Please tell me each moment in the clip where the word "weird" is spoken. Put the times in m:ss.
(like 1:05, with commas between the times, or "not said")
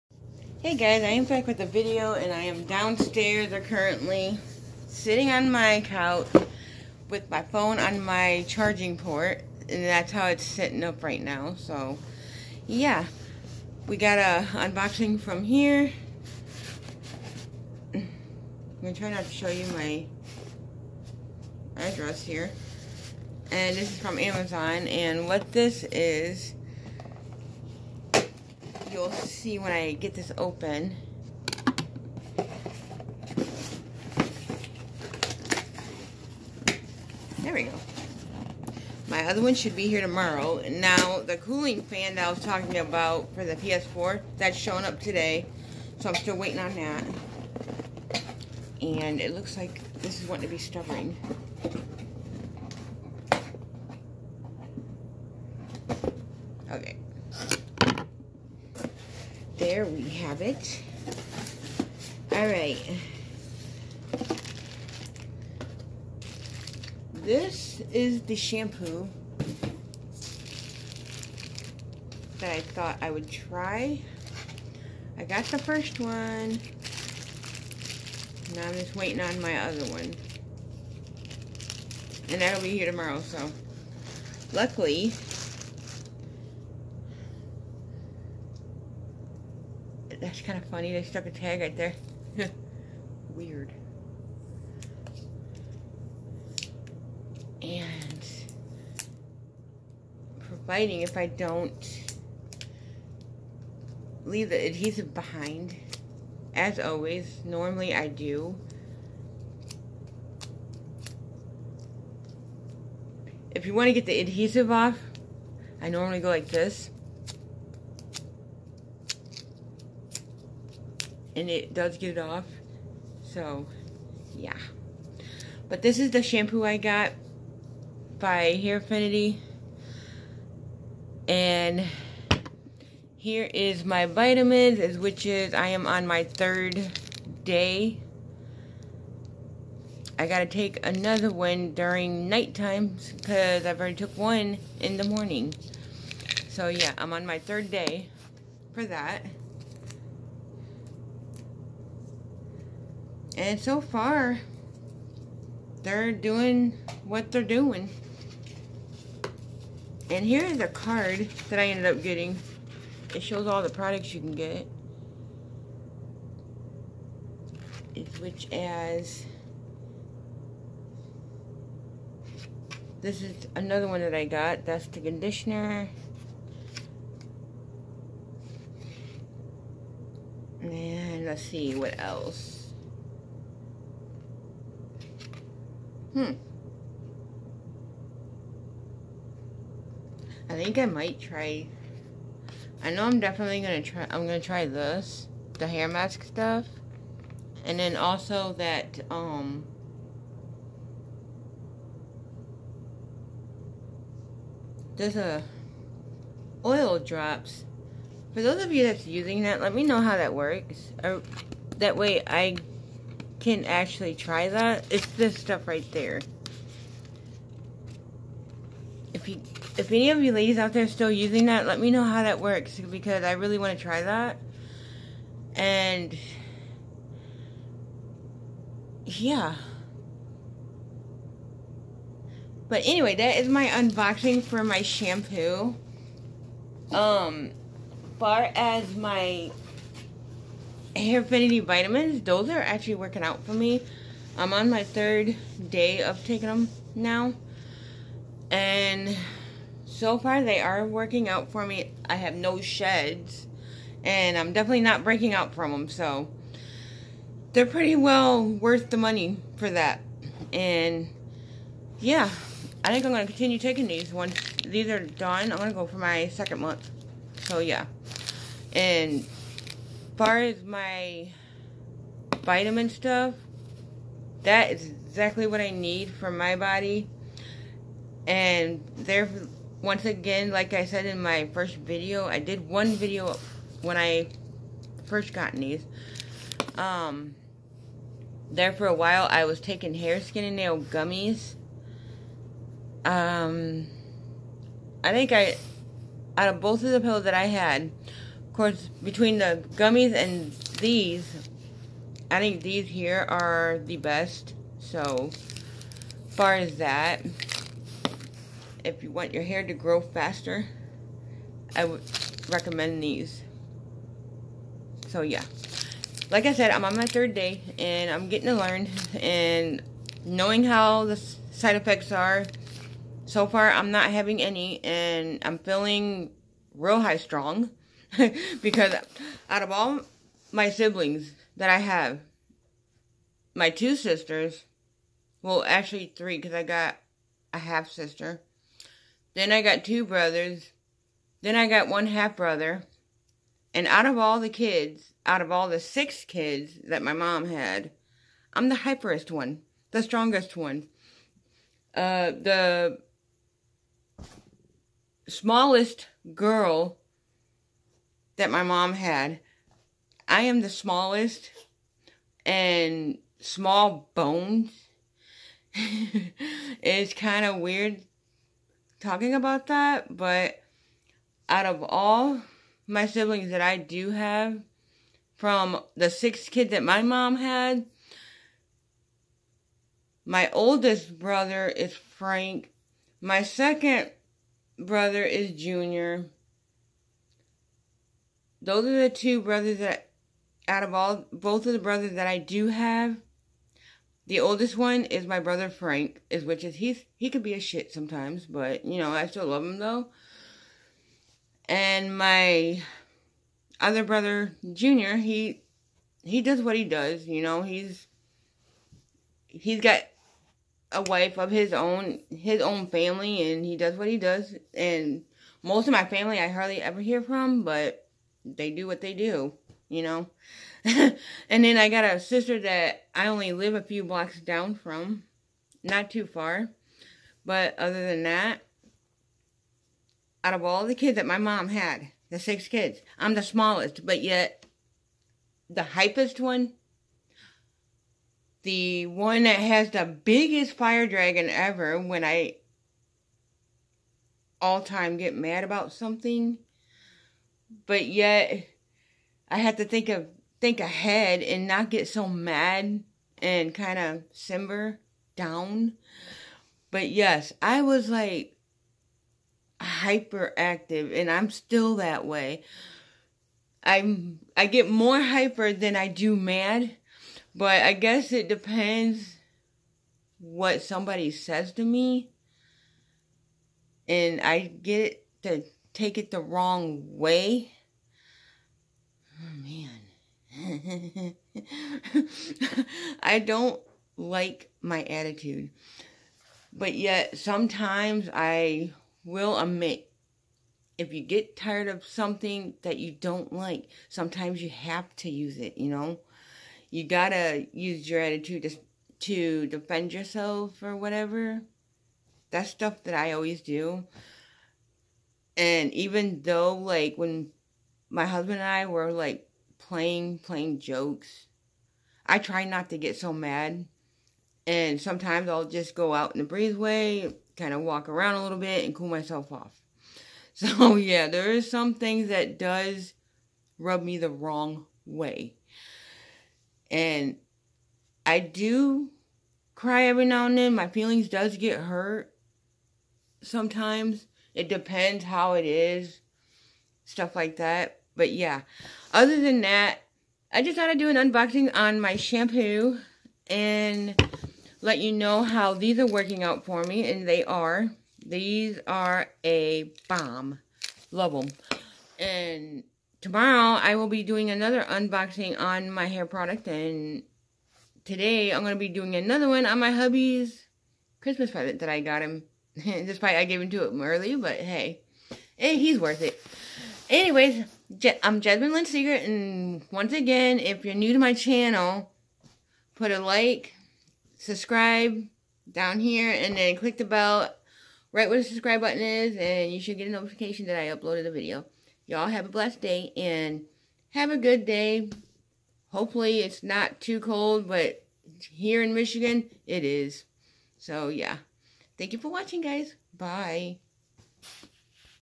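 1:33, 6:07.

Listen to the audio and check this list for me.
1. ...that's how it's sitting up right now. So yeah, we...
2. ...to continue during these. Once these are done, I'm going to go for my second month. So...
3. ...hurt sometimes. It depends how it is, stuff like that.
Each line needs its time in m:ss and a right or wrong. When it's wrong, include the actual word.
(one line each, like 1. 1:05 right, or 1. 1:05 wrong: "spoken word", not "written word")
1. 0:09 right
2. 4:23 wrong: "taking", not "during"
3. 8:51 right.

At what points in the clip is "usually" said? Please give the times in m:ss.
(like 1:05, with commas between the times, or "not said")
not said.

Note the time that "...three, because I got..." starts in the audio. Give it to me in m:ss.
5:36.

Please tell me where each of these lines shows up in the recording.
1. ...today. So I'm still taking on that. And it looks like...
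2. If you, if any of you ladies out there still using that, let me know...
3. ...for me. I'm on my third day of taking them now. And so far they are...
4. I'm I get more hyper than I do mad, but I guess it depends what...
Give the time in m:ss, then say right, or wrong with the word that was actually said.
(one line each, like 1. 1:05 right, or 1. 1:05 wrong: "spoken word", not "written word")
1. 0:44 wrong: "waiting", not "taking"
2. 3:39 right
3. 4:03 right
4. 7:43 right.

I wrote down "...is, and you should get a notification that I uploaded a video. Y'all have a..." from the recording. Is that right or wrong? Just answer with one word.
right.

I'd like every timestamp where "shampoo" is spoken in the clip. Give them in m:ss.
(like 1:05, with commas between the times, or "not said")
1:08, 2:06, 3:54, 9:02.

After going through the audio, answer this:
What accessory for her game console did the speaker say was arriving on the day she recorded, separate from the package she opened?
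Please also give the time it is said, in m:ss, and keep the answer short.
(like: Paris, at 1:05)
cooling fan, at 0:41.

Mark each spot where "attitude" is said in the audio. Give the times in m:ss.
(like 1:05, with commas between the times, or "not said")
8:05, 8:18.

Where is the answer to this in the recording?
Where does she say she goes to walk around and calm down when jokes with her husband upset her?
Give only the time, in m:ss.
8:36.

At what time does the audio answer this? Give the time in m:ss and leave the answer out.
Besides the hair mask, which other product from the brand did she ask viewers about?
3:26.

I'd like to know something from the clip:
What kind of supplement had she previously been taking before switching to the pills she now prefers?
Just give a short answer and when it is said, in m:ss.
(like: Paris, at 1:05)
hair, skin, and nail gummies, at 4:49.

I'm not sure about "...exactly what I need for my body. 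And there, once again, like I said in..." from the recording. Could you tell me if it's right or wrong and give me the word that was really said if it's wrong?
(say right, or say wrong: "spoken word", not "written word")
right.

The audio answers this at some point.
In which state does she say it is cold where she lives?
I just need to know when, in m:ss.
9:48.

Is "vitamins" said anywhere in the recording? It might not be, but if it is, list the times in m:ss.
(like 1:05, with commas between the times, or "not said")
2:14, 4:01, 4:32.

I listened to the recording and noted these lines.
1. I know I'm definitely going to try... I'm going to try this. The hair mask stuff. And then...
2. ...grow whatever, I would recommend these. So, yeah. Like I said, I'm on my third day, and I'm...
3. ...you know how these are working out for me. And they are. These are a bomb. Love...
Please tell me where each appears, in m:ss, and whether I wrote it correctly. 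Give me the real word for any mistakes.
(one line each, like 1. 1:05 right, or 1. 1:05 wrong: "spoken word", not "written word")
1. 3:12 right
2. 5:09 wrong: "faster", not "whatever"
3. 9:04 right.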